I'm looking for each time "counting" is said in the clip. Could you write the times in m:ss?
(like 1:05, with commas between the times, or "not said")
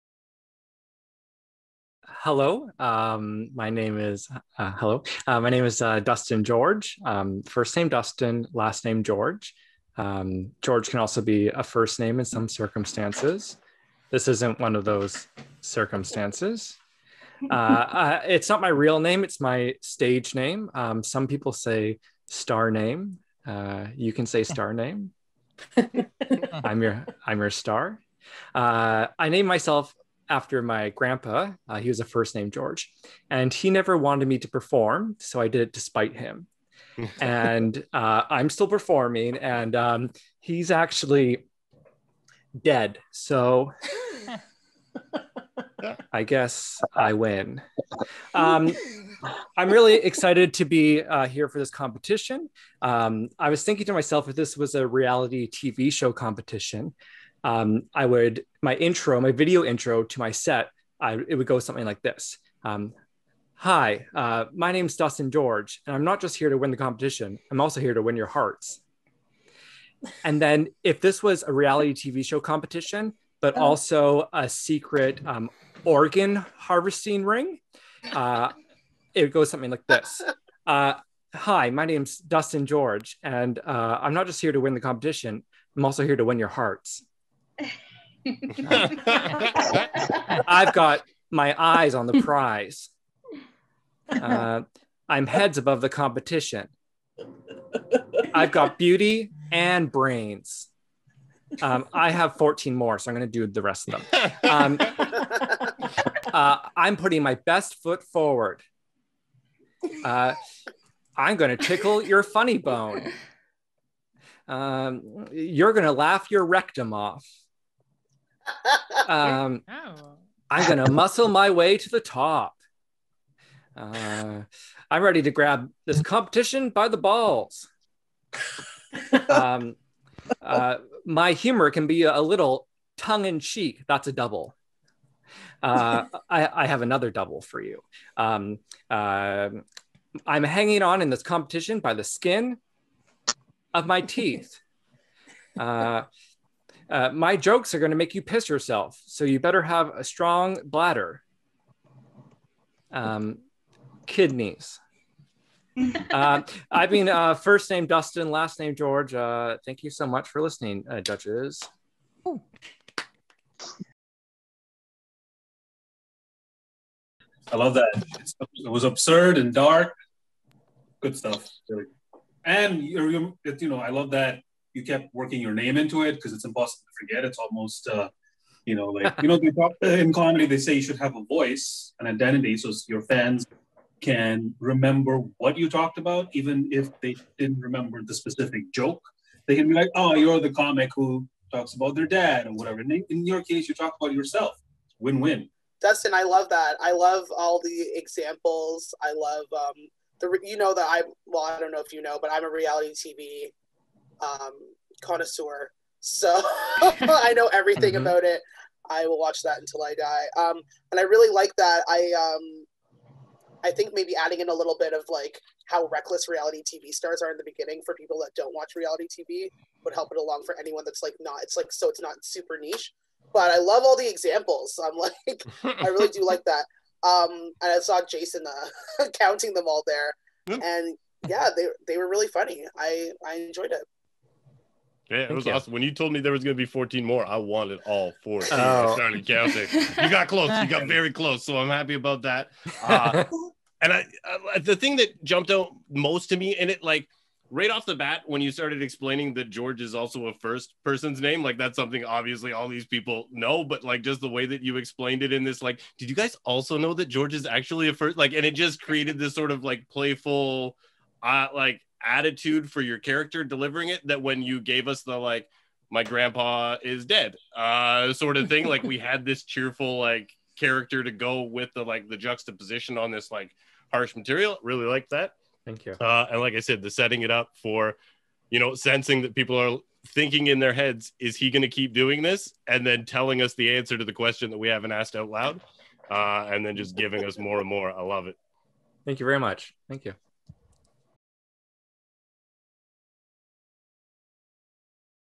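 3:49, 3:59.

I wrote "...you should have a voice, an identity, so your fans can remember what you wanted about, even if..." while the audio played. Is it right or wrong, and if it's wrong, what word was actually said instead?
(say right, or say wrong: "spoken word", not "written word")
wrong: "talked", not "wanted".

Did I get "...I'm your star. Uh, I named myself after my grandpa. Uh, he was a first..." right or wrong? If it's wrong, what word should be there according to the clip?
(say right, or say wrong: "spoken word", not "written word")
right.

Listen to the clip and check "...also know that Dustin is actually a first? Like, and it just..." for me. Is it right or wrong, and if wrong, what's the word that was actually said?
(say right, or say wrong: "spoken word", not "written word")
wrong: "George", not "Dustin".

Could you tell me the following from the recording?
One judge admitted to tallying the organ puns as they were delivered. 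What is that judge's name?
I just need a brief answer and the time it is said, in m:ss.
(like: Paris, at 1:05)
Jason, at 3:48.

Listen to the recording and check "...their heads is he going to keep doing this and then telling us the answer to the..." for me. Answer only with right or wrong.
right.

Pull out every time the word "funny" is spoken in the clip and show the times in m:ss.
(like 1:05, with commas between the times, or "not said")
1:52, 3:52.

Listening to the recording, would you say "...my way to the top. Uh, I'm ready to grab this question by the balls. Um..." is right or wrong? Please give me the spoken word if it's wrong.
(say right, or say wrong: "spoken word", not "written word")
wrong: "competition", not "question".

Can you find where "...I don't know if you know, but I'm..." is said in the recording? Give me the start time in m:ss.
3:21.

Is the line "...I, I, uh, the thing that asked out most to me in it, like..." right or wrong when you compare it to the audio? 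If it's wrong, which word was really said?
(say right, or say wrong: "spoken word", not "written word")
wrong: "jumped", not "asked".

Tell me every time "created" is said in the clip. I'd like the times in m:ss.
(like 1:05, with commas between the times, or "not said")
4:18.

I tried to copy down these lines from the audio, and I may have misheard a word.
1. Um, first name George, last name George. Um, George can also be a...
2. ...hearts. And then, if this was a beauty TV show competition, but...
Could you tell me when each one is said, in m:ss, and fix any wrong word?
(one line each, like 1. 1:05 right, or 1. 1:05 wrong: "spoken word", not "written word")
1. 0:07 wrong: "Dustin", not "George"
2. 1:08 wrong: "reality", not "beauty".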